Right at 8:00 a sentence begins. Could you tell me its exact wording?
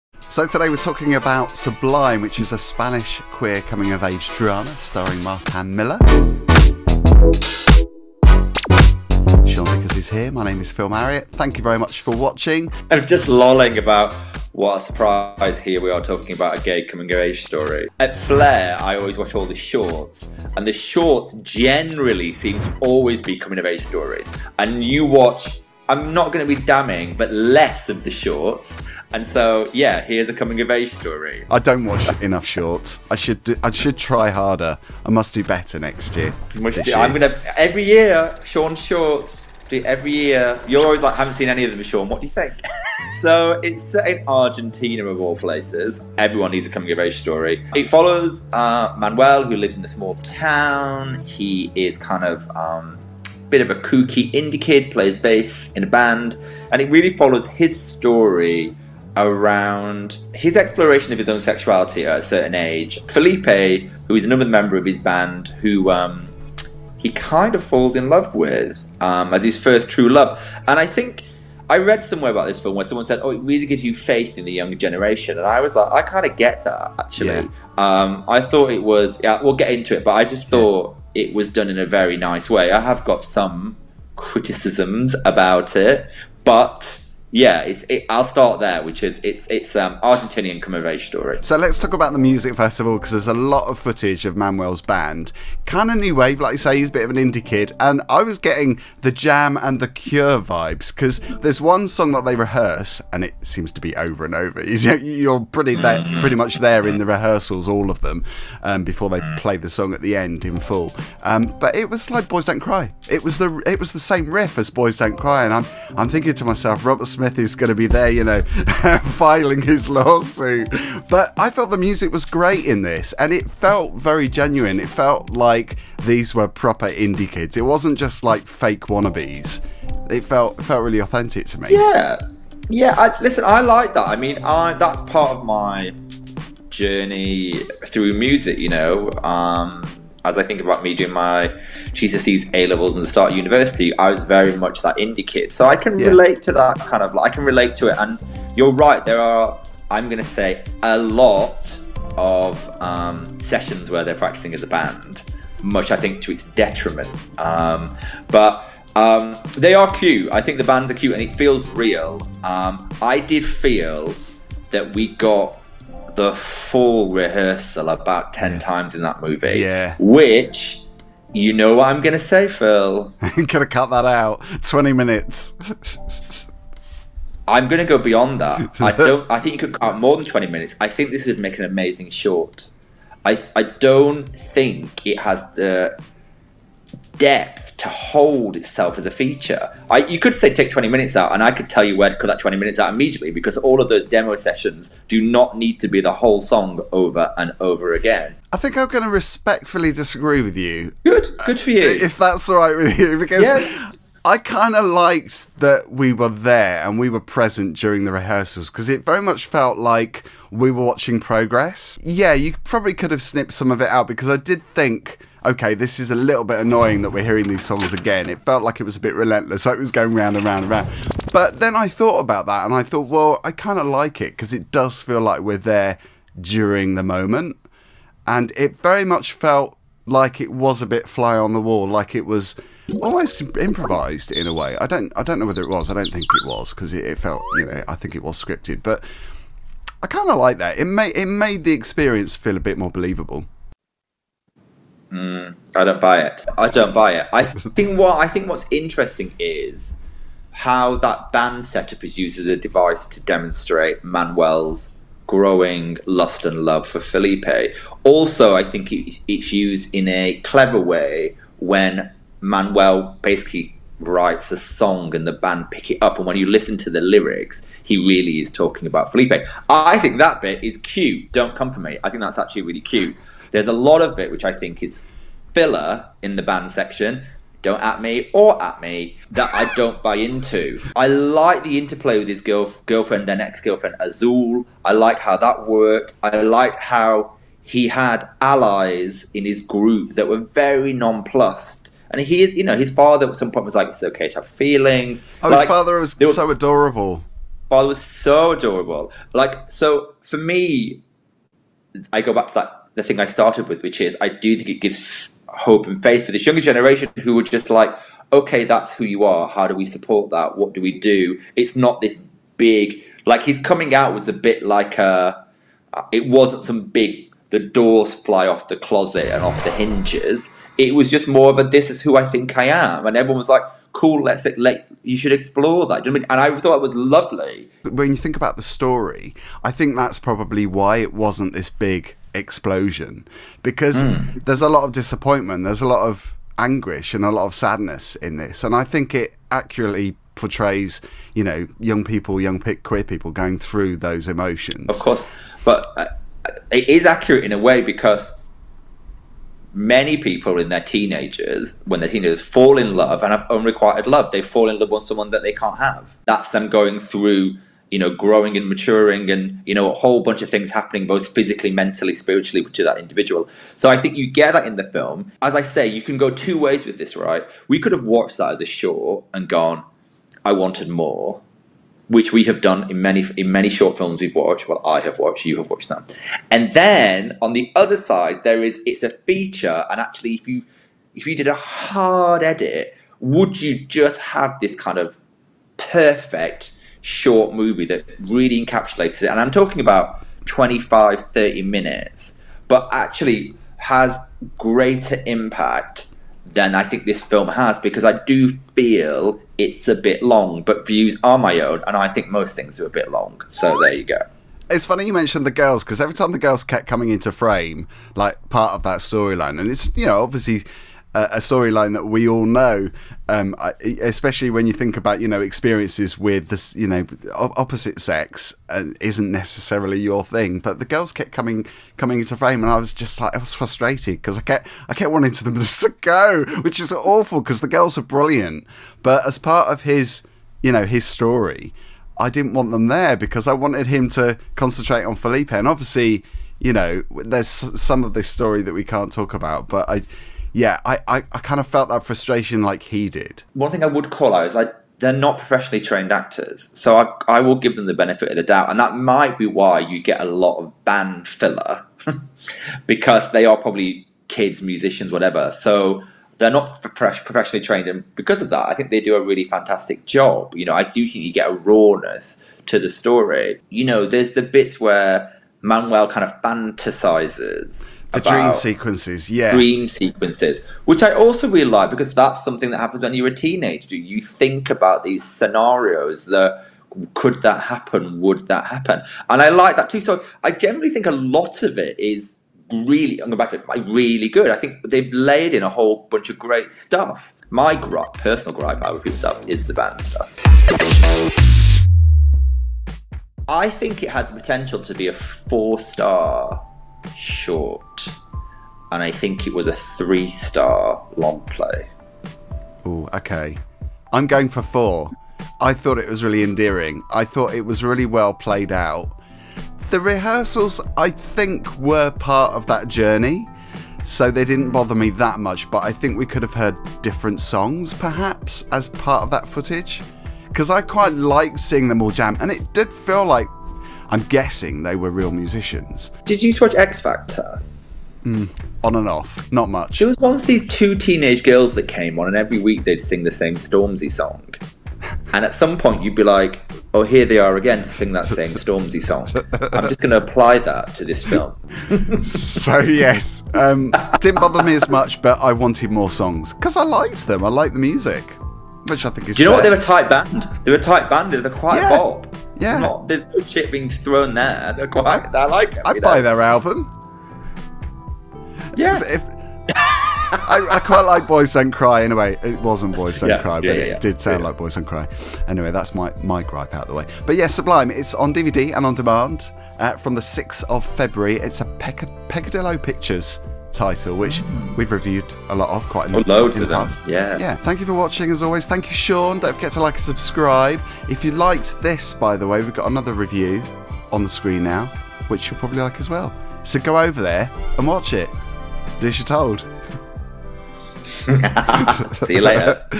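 So I generally think a lot of it is really, I'm going back to it, really good.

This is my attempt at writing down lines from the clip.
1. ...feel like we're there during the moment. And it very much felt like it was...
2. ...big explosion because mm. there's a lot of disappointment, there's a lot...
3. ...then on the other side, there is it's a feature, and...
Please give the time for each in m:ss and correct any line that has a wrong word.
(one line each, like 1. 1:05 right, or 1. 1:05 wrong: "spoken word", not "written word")
1. 3:45 right
2. 5:31 right
3. 6:16 right.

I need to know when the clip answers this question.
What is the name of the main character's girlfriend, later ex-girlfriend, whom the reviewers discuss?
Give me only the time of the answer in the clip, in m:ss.
4:43.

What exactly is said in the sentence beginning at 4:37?
Don't at me or at me that I don't buy into.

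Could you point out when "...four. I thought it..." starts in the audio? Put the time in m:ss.
8:24.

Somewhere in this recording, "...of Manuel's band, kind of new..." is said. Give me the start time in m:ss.
1:34.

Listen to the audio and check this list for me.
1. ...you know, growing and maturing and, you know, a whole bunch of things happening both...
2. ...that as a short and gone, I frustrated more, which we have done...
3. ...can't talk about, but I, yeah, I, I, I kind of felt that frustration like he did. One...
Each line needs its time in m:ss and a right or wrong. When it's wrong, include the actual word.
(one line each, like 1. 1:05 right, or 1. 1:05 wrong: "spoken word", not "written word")
1. 5:57 right
2. 6:08 wrong: "wanted", not "frustrated"
3. 7:18 right.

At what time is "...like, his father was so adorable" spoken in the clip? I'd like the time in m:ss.
4:55.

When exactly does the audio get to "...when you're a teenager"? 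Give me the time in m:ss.
7:53.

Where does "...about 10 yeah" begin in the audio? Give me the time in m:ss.
2:47.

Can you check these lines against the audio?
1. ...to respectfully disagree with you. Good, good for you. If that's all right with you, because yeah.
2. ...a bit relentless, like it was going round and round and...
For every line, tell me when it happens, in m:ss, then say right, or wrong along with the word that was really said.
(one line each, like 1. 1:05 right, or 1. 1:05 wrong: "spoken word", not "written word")
1. 3:19 right
2. 3:38 right.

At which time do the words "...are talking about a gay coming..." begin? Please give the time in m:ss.
0:15.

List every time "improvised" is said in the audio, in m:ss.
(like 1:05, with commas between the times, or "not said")
3:53.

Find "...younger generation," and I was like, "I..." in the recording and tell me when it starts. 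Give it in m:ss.
1:14.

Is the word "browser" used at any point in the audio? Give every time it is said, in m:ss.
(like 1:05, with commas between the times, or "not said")
not said.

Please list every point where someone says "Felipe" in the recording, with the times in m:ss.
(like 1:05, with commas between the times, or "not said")
1:03, 4:16, 4:29, 7:15.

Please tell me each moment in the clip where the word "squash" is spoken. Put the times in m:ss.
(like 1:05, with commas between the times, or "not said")
not said.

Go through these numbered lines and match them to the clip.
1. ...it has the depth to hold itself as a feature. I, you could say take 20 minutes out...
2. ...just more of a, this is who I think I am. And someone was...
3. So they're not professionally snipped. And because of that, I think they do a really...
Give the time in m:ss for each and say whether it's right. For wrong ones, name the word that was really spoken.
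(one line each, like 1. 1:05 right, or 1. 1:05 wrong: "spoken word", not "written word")
1. 3:05 right
2. 5:21 wrong: "everyone", not "someone"
3. 7:35 wrong: "trained", not "snipped".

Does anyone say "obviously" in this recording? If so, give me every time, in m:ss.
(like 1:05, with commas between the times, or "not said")
6:50, 7:15.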